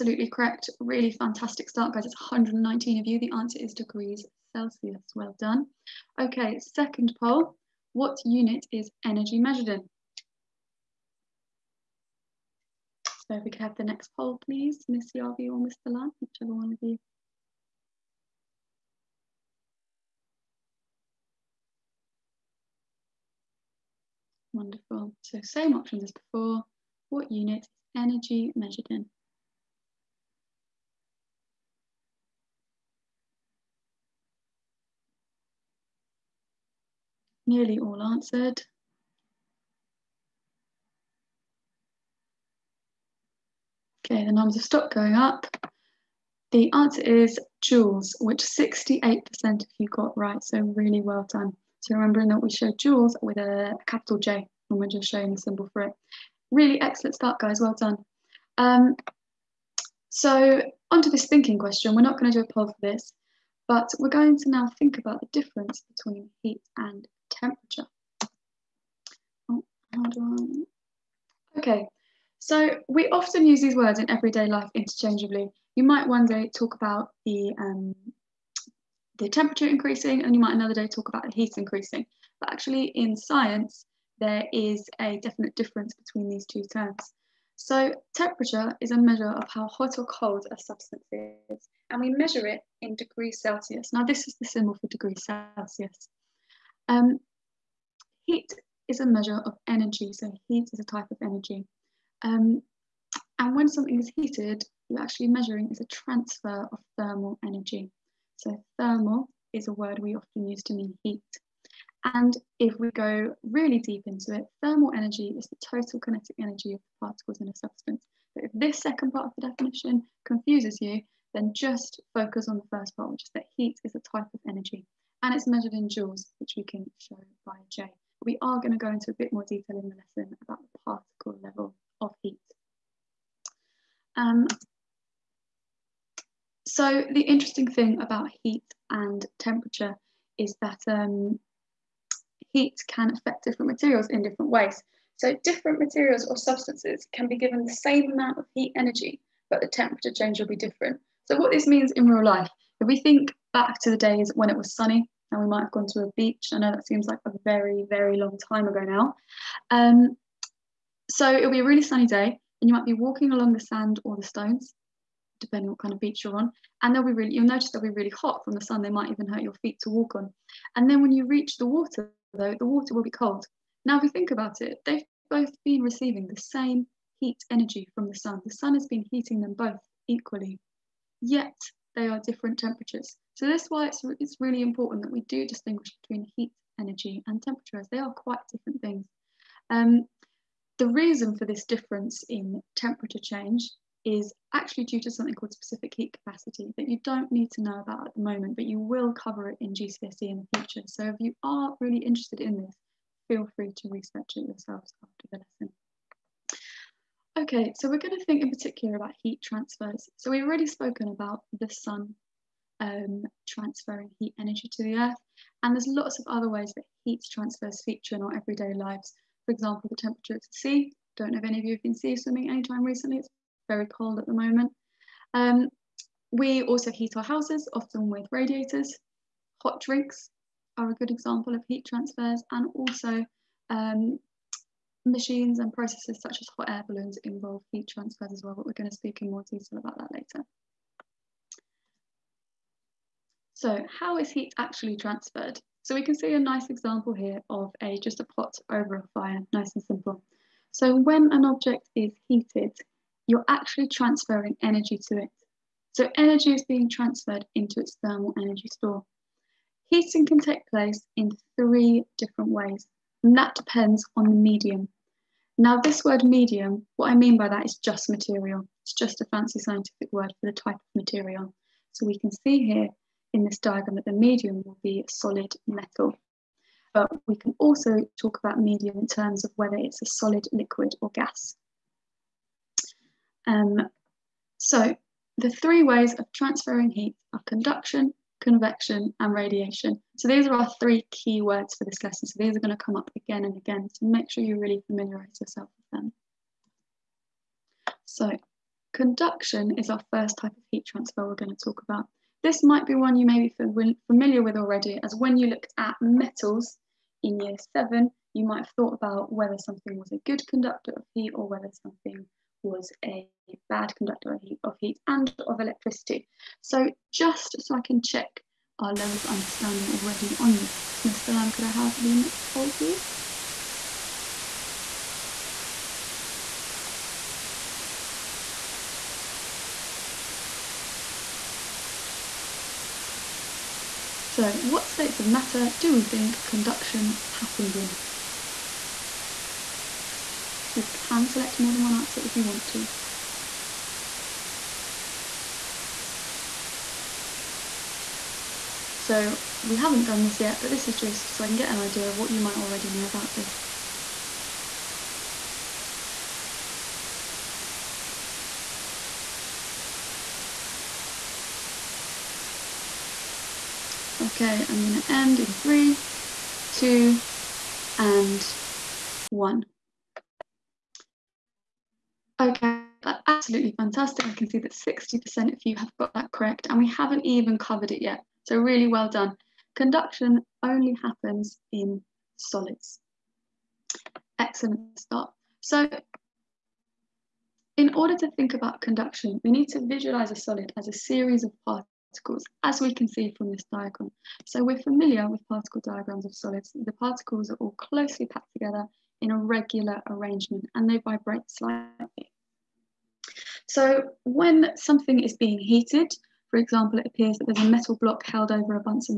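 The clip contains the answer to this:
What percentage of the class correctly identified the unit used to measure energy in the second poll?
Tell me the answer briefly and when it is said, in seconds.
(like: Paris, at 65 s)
68%, at 48 s.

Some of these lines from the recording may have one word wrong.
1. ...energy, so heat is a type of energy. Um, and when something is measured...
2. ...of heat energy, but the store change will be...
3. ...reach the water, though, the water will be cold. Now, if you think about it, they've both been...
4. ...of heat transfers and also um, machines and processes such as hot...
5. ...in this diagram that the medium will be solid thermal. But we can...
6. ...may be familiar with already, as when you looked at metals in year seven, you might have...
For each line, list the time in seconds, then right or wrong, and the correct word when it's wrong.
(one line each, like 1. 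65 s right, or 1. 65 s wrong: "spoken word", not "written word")
1. 99 s wrong: "heated", not "measured"
2. 148 s wrong: "temperature", not "store"
3. 171 s right
4. 231 s right
5. 273 s wrong: "metal", not "thermal"
6. 303 s right.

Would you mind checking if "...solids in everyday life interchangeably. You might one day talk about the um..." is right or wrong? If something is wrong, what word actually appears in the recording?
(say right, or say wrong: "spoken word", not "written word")
wrong: "words", not "solids".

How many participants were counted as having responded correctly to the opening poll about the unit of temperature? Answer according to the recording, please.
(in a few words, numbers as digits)
119.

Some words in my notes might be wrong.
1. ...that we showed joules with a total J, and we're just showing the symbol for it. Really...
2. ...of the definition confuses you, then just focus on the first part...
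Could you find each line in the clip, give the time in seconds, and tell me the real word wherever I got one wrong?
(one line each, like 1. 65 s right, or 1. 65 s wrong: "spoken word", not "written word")
1. 52 s wrong: "capital", not "total"
2. 119 s right.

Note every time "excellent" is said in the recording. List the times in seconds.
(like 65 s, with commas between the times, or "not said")
56 s, 384 s.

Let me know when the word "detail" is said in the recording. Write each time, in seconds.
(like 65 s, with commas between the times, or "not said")
129 s, 239 s.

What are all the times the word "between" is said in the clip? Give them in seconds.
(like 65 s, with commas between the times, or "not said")
65 s, 85 s, 186 s.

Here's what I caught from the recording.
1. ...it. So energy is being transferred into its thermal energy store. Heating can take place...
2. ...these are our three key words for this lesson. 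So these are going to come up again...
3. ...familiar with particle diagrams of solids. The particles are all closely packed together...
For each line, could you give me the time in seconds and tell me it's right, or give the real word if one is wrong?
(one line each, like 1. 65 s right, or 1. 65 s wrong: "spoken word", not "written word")
1. 255 s right
2. 290 s right
3. 394 s right.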